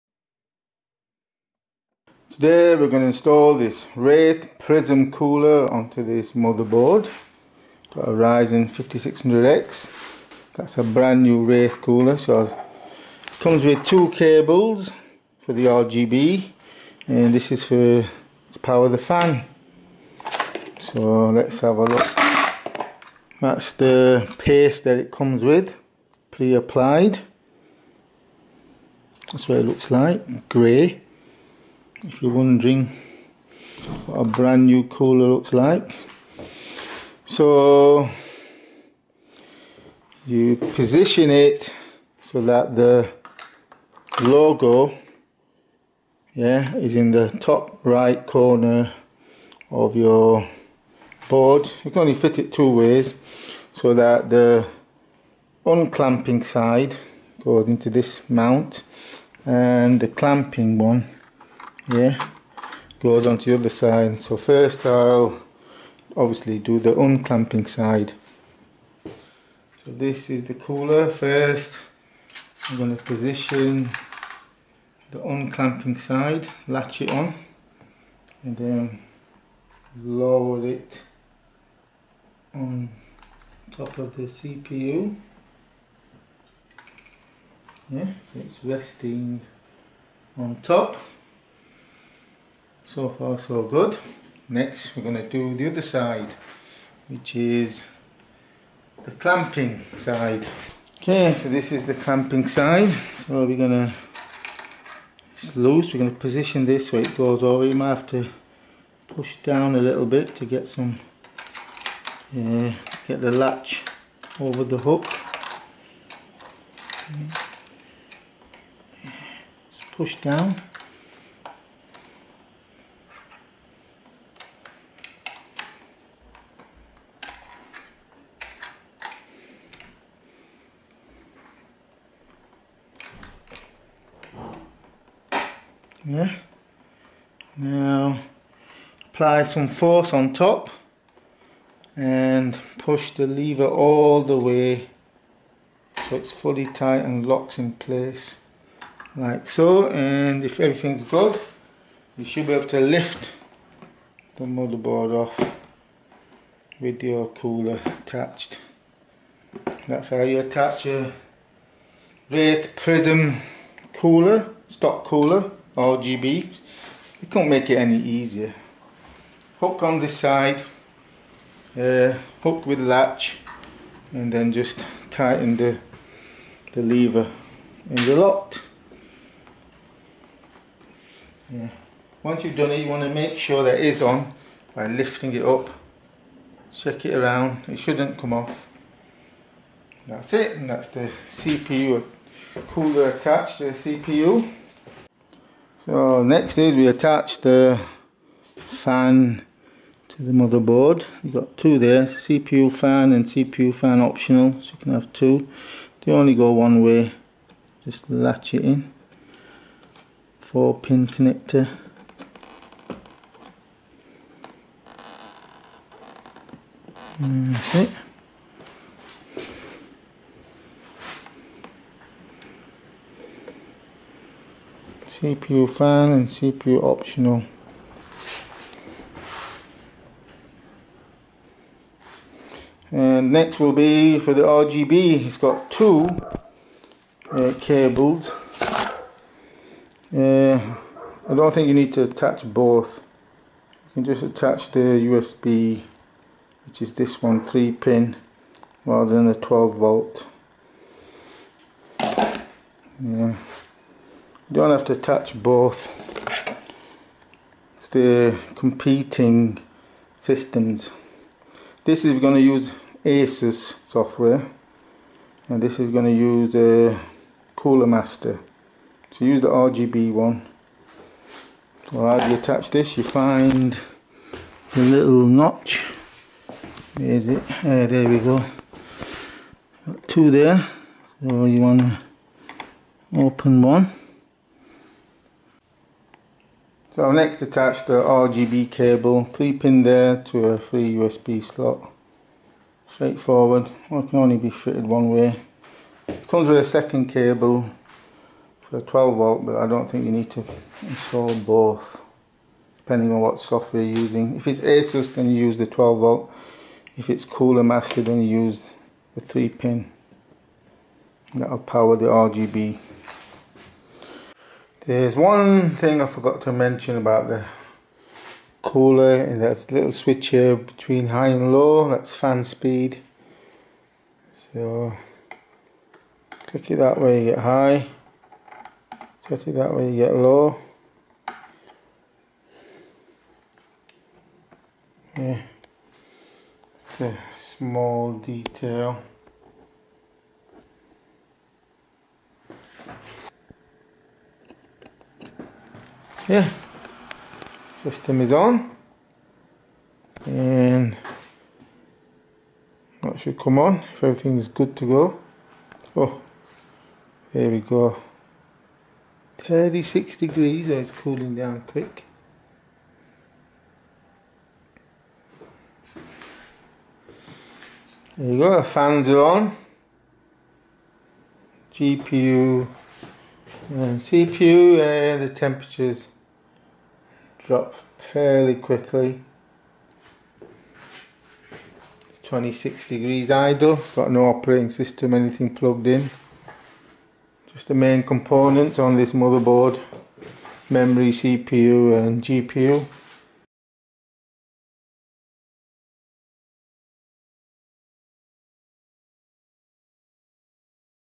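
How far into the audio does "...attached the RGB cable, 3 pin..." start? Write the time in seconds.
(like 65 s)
287 s.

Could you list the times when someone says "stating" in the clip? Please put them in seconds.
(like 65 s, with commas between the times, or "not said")
not said.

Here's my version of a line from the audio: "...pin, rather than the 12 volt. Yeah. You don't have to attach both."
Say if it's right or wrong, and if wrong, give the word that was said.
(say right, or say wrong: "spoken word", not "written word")
right.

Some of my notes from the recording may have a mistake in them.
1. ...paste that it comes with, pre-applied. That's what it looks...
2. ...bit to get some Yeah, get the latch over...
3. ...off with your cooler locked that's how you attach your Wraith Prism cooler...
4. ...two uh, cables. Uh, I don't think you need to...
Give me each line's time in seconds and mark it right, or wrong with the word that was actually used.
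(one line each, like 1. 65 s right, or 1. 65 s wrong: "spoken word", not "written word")
1. 24 s right
2. 110 s right
3. 155 s wrong: "attached", not "locked"
4. 235 s right.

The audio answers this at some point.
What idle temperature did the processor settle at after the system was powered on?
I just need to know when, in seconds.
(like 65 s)
382 s.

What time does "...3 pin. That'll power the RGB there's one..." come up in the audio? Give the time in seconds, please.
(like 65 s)
309 s.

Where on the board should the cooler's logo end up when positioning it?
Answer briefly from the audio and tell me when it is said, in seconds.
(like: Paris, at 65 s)
Top right corner, at 47 s.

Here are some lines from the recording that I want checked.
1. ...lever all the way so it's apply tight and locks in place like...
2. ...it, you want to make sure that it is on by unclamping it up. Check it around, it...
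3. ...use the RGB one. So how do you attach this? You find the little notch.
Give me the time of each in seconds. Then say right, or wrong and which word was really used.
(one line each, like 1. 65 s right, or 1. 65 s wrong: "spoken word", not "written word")
1. 143 s wrong: "fully", not "apply"
2. 182 s wrong: "lifting", not "unclamping"
3. 269 s right.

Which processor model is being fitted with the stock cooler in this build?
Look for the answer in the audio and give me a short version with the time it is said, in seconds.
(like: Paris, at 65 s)
Ryzen 5600X, at 8 s.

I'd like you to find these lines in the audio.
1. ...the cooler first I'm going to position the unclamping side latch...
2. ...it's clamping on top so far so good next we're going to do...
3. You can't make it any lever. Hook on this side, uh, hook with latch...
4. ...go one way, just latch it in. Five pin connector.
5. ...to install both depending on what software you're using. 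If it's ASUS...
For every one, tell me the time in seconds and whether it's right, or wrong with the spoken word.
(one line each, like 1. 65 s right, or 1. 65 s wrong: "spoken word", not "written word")
1. 70 s right
2. 88 s wrong: "resting", not "clamping"
3. 167 s wrong: "easier", not "lever"
4. 206 s wrong: "Four", not "Five"
5. 300 s right.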